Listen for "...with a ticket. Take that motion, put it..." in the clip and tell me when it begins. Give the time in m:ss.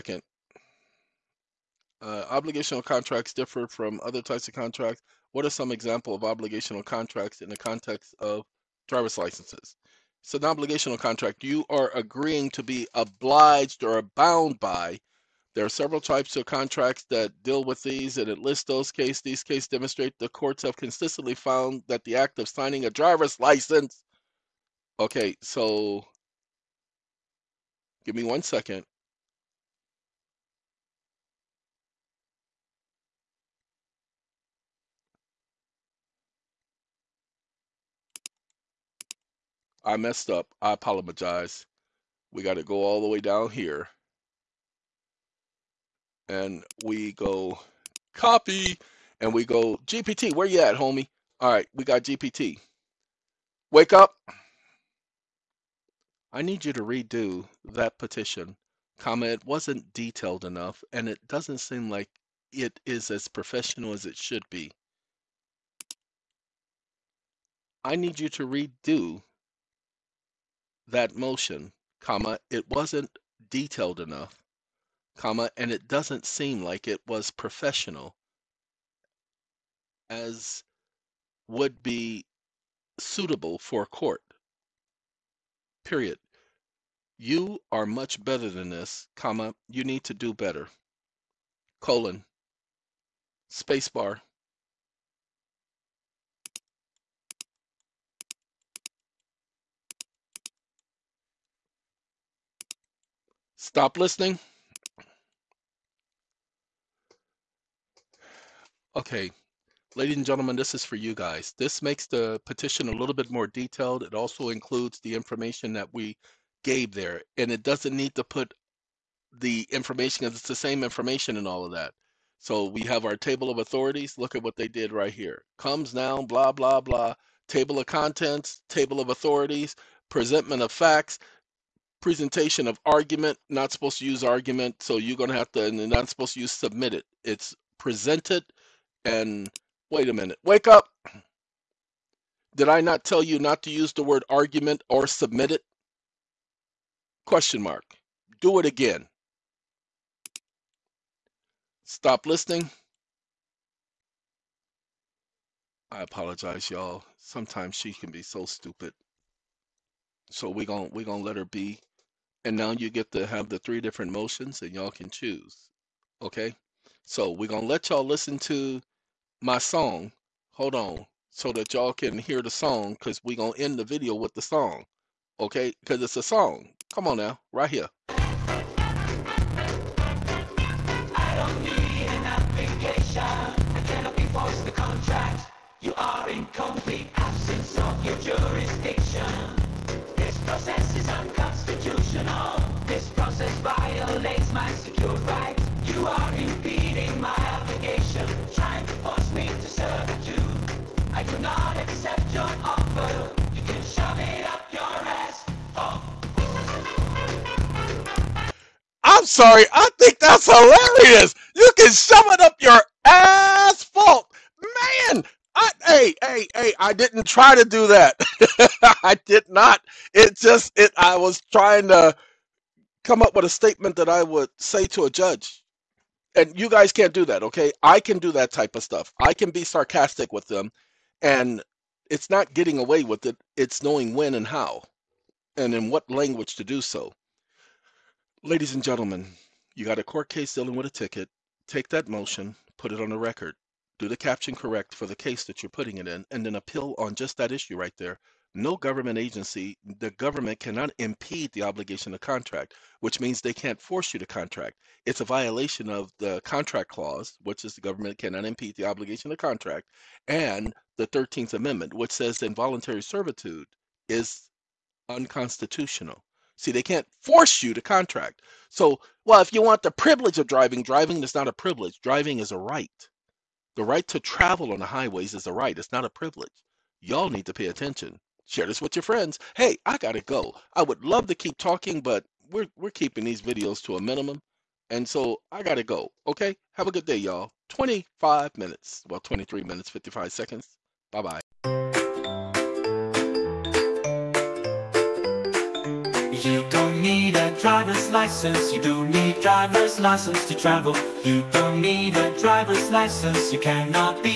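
4:00.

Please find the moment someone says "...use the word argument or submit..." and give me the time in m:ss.
2:23.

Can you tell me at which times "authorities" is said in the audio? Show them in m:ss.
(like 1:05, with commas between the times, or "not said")
2:03, 2:09.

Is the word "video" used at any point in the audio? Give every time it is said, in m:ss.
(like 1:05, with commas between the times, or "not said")
2:53, 4:43.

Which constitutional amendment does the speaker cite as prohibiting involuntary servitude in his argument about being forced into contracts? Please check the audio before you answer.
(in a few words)
13th Amendment.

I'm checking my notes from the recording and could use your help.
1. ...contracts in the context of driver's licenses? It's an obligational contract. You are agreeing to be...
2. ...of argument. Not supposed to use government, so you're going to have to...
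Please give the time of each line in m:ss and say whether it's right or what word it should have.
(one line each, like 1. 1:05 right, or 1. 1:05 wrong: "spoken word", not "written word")
1. 0:06 right
2. 2:12 wrong: "argument", not "government".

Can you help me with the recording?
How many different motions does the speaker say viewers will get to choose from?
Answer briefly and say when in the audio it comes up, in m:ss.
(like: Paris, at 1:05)
3, at 2:43.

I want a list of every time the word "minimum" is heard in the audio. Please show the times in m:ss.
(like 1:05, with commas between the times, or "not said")
4:44.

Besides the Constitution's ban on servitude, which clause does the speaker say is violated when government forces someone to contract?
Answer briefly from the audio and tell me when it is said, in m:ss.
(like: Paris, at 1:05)
contract clause, at 4:16.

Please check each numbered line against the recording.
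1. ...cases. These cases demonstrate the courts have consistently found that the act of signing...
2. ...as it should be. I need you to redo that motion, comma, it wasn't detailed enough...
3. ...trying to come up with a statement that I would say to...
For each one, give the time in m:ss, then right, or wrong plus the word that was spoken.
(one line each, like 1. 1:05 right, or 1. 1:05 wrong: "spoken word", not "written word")
1. 0:18 right
2. 1:03 right
3. 3:41 right.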